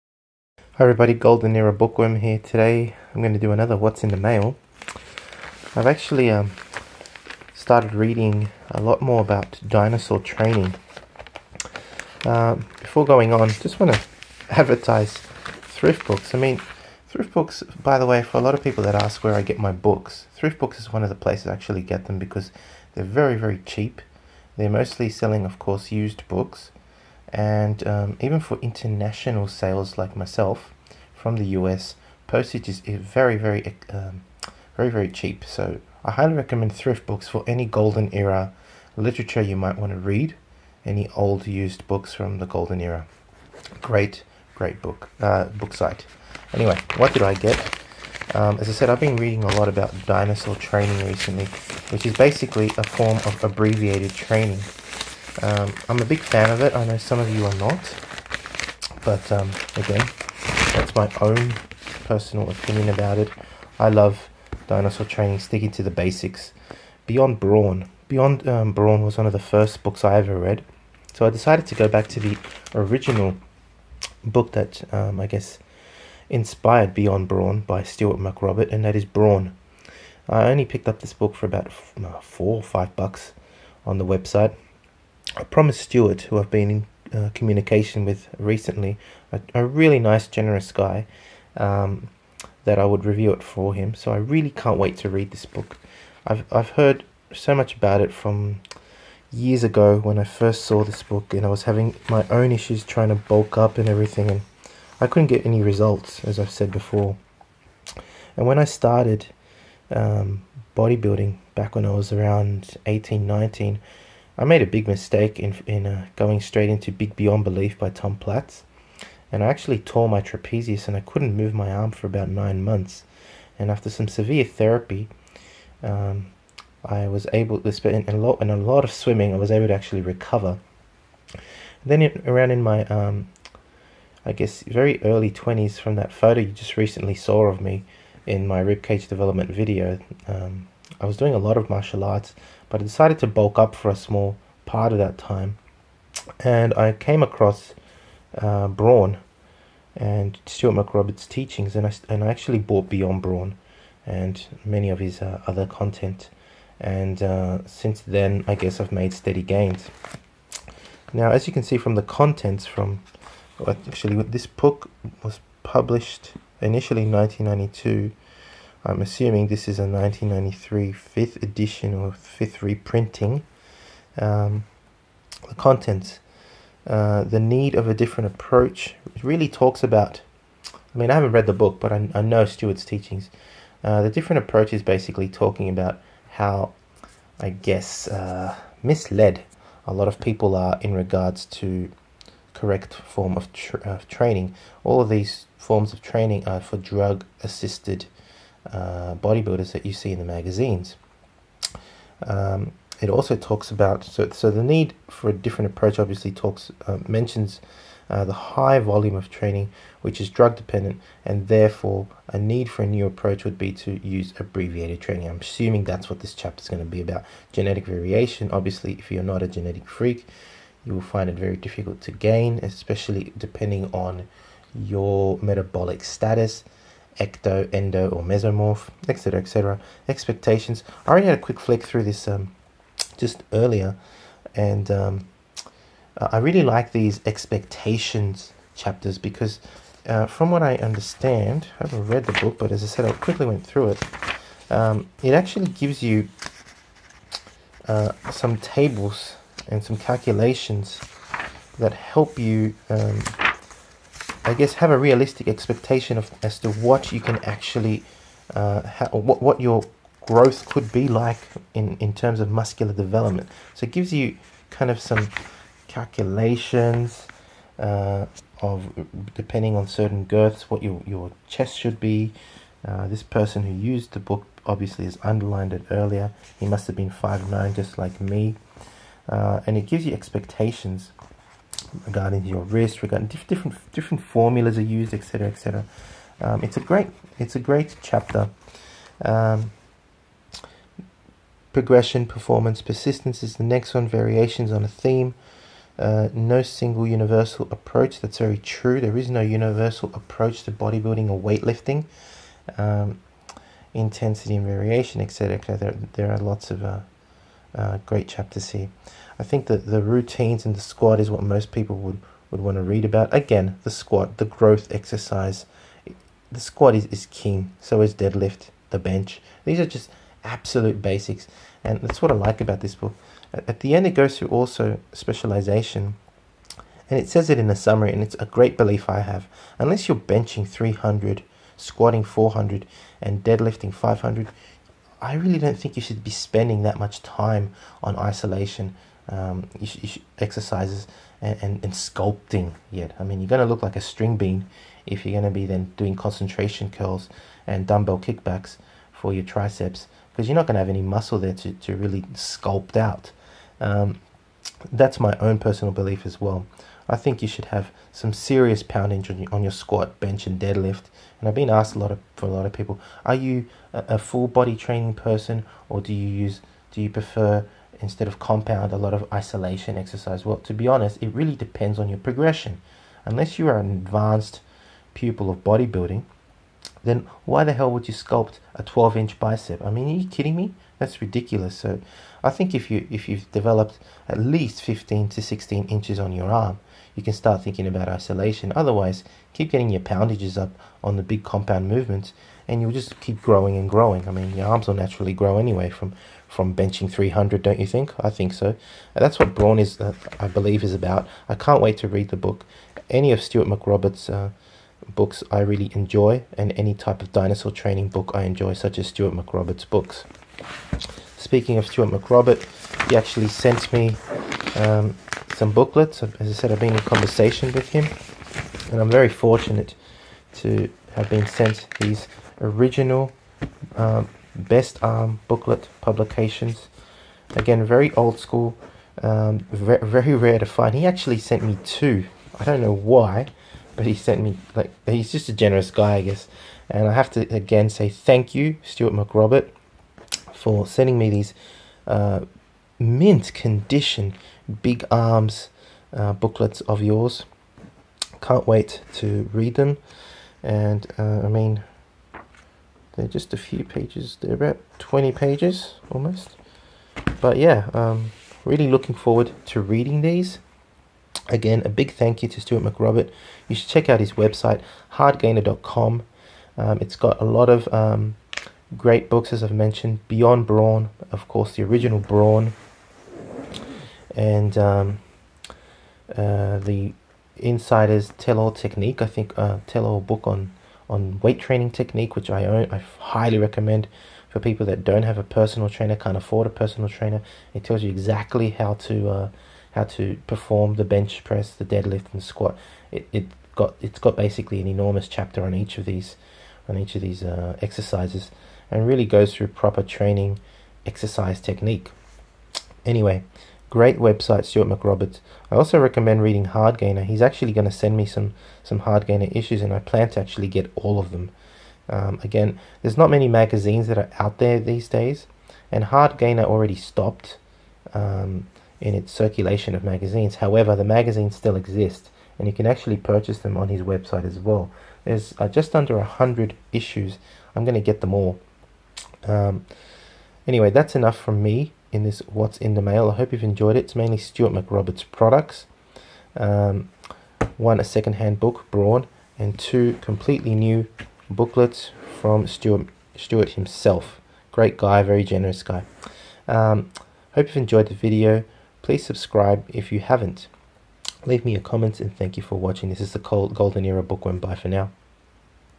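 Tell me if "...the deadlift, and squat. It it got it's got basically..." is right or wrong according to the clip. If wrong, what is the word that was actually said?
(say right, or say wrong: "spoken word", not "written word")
right.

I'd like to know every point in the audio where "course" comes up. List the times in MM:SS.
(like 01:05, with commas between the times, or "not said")
00:25, 07:51.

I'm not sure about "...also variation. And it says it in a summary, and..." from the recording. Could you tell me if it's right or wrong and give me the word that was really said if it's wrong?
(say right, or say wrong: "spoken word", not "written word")
wrong: "specialization", not "variation".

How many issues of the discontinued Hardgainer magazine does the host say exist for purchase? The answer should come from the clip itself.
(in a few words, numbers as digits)
Just under 100.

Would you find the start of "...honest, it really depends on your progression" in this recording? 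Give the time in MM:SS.
06:10.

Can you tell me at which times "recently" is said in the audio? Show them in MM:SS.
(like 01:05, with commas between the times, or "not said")
00:51, 01:28, 02:16.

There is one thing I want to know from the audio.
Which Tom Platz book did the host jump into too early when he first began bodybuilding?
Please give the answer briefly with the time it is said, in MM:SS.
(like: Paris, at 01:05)
Big Beyond Belief, at 01:56.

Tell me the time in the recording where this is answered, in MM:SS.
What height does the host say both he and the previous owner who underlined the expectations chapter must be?
04:37.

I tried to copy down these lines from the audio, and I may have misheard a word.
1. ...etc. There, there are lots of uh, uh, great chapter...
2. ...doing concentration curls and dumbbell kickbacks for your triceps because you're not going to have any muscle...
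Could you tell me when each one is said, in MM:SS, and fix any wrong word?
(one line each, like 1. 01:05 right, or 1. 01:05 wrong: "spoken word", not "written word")
1. 05:05 right
2. 05:45 right.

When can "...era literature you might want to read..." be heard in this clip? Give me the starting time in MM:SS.
00:38.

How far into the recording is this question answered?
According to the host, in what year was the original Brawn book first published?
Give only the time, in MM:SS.
02:47.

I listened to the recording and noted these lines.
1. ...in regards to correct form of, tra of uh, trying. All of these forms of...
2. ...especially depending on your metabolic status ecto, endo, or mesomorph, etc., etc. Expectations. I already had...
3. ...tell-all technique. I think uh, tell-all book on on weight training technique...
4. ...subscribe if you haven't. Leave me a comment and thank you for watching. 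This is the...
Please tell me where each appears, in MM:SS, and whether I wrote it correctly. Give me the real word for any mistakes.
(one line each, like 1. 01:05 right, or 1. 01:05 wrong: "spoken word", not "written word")
1. 03:10 wrong: "training", not "trying"
2. 03:42 right
3. 07:58 right
4. 09:09 right.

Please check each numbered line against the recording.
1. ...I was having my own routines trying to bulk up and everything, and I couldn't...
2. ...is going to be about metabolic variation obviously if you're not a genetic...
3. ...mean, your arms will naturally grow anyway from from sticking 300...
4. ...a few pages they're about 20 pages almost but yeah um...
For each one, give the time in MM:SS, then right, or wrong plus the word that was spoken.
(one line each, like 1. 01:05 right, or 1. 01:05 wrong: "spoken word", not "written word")
1. 01:41 wrong: "issues", not "routines"
2. 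03:36 wrong: "genetic", not "metabolic"
3. 06:34 wrong: "benching", not "sticking"
4. 07:33 right.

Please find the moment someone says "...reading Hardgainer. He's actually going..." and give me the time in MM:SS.
08:26.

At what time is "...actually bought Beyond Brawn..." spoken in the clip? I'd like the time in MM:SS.
02:32.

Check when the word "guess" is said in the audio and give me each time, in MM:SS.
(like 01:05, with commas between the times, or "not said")
01:15, 02:14, 02:38, 03:07, 04:14, 07:16.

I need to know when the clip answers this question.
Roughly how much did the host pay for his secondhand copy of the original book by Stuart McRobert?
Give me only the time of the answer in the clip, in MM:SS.
01:22.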